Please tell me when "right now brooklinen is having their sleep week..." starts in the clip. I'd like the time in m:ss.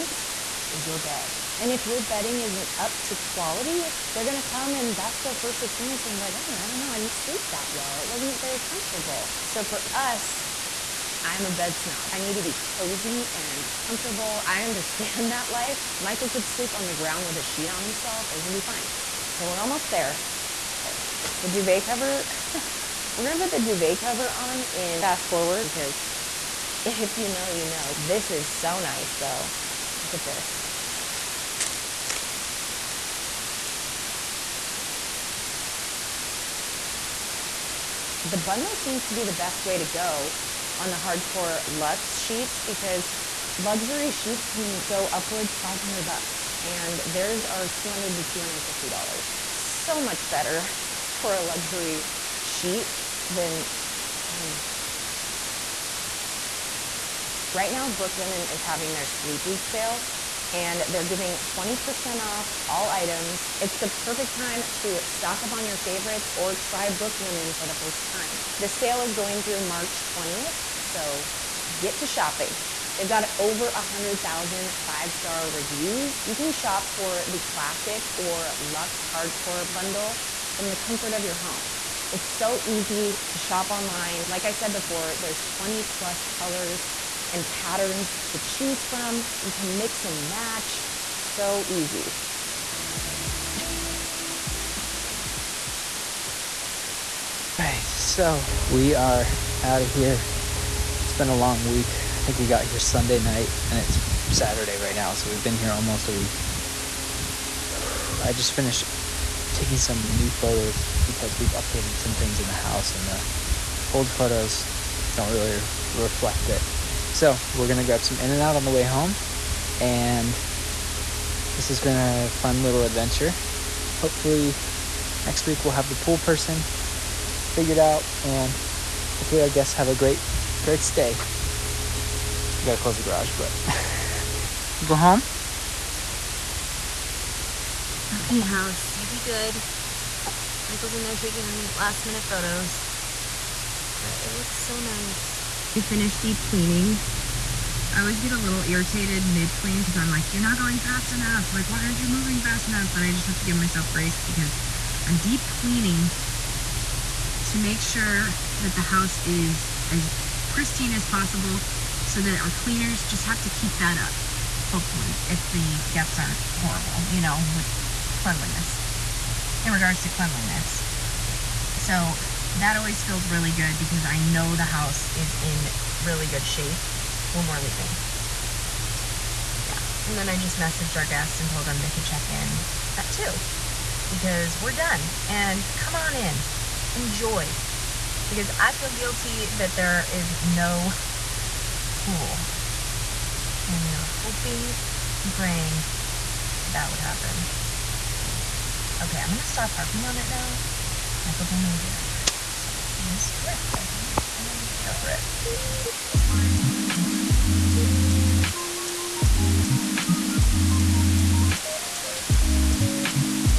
0:57.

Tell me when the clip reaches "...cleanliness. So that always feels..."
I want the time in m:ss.
2:50.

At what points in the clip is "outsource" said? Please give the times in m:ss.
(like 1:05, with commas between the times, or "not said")
not said.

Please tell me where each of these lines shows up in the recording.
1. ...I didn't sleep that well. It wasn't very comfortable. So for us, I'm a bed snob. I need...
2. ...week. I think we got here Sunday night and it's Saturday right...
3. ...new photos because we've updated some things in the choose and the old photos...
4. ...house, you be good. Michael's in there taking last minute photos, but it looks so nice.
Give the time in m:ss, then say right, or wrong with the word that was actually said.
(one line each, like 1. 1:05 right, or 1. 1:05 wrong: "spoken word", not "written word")
1. 0:06 right
2. 1:41 right
3. 1:50 wrong: "house", not "choose"
4. 2:18 right.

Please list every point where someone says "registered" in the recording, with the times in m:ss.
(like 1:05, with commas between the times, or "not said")
not said.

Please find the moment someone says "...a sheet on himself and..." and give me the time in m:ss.
0:17.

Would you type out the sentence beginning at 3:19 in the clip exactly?
Okay, I'm gonna stop harping on it now.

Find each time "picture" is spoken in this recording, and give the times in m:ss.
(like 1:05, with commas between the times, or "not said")
not said.